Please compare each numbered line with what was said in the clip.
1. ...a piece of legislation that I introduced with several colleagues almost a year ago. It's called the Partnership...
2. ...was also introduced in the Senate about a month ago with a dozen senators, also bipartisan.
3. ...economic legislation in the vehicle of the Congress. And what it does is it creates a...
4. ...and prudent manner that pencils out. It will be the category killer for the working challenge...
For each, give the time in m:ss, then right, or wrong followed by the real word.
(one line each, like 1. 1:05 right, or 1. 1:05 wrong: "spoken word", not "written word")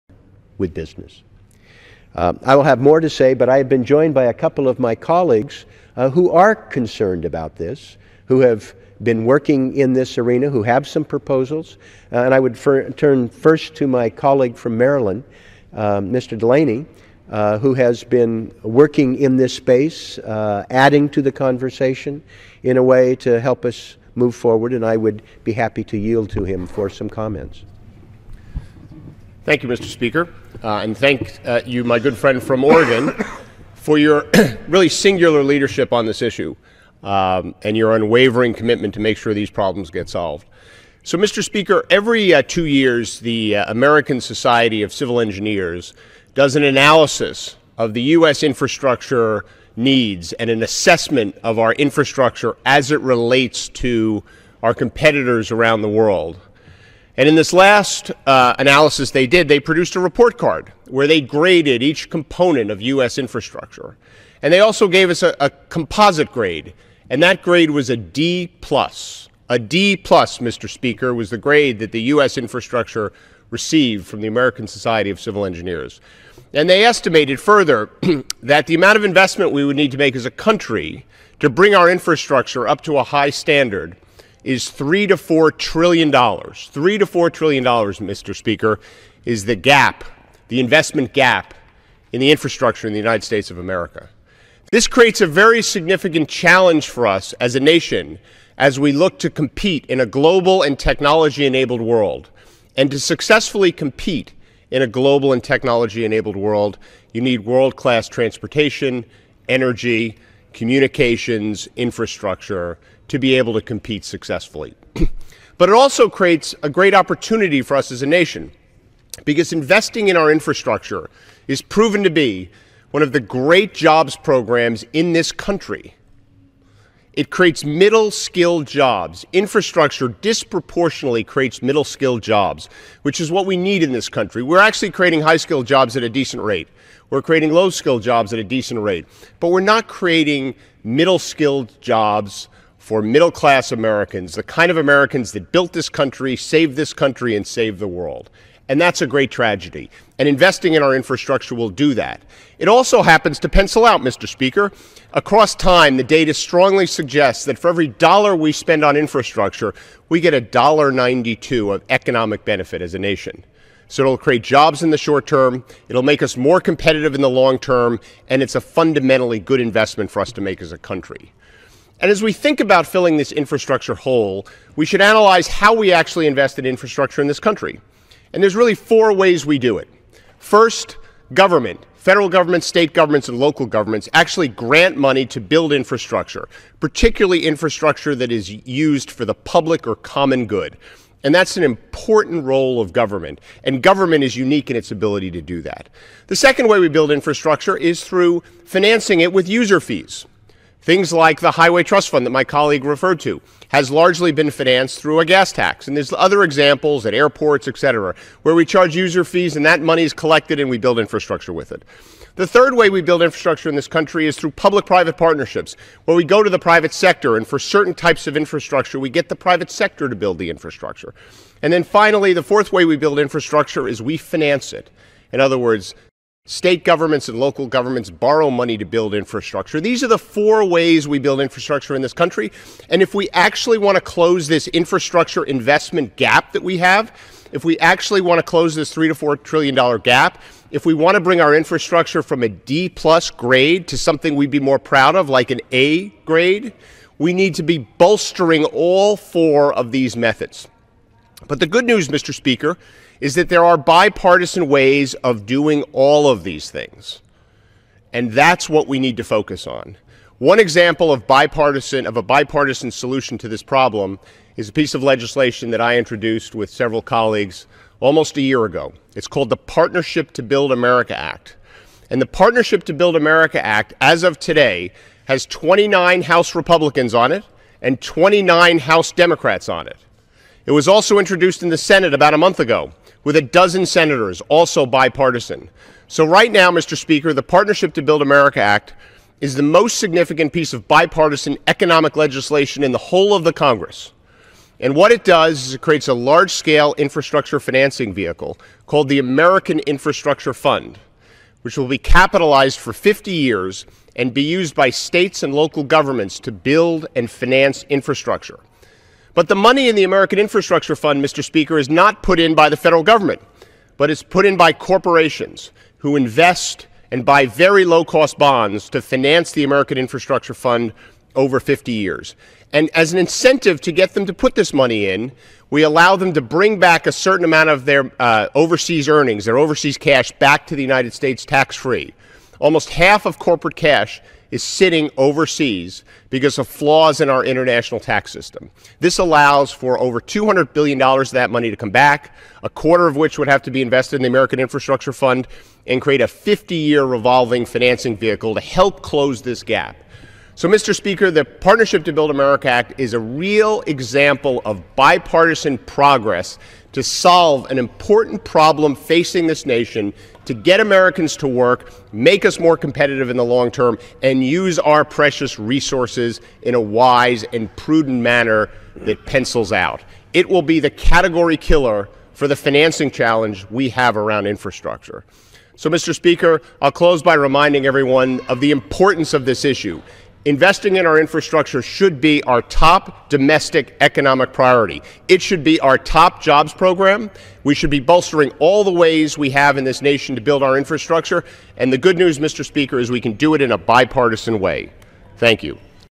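1. 4:24 right
2. 4:40 right
3. 4:51 wrong: "whole", not "vehicle"
4. 6:07 wrong: "financing", not "working".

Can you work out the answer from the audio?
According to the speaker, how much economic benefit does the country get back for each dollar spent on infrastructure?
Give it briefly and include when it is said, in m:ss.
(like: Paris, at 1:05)
$1.92, at 2:40.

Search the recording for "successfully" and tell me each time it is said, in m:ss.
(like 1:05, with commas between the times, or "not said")
1:42, 1:54.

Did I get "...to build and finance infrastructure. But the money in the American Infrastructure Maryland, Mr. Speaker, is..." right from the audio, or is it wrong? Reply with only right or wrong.
wrong.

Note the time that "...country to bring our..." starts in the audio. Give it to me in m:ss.
1:20.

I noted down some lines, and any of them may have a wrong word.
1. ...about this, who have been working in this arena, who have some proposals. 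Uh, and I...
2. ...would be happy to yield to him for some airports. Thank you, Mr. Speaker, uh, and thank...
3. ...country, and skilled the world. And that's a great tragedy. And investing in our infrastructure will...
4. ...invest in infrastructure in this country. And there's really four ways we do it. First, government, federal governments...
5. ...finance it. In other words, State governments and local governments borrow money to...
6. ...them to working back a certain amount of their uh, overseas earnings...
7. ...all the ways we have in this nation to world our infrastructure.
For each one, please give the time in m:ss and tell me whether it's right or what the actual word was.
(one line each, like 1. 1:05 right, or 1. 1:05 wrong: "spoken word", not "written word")
1. 0:07 right
2. 0:24 wrong: "comments", not "airports"
3. 2:26 wrong: "saved", not "skilled"
4. 2:56 right
5. 3:44 right
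6. 5:26 wrong: "bring", not "working"
7. 6:28 wrong: "build", not "world".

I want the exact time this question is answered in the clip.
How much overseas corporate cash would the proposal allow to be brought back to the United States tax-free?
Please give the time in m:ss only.
5:39.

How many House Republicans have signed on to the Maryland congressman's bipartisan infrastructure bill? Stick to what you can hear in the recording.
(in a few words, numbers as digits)
29.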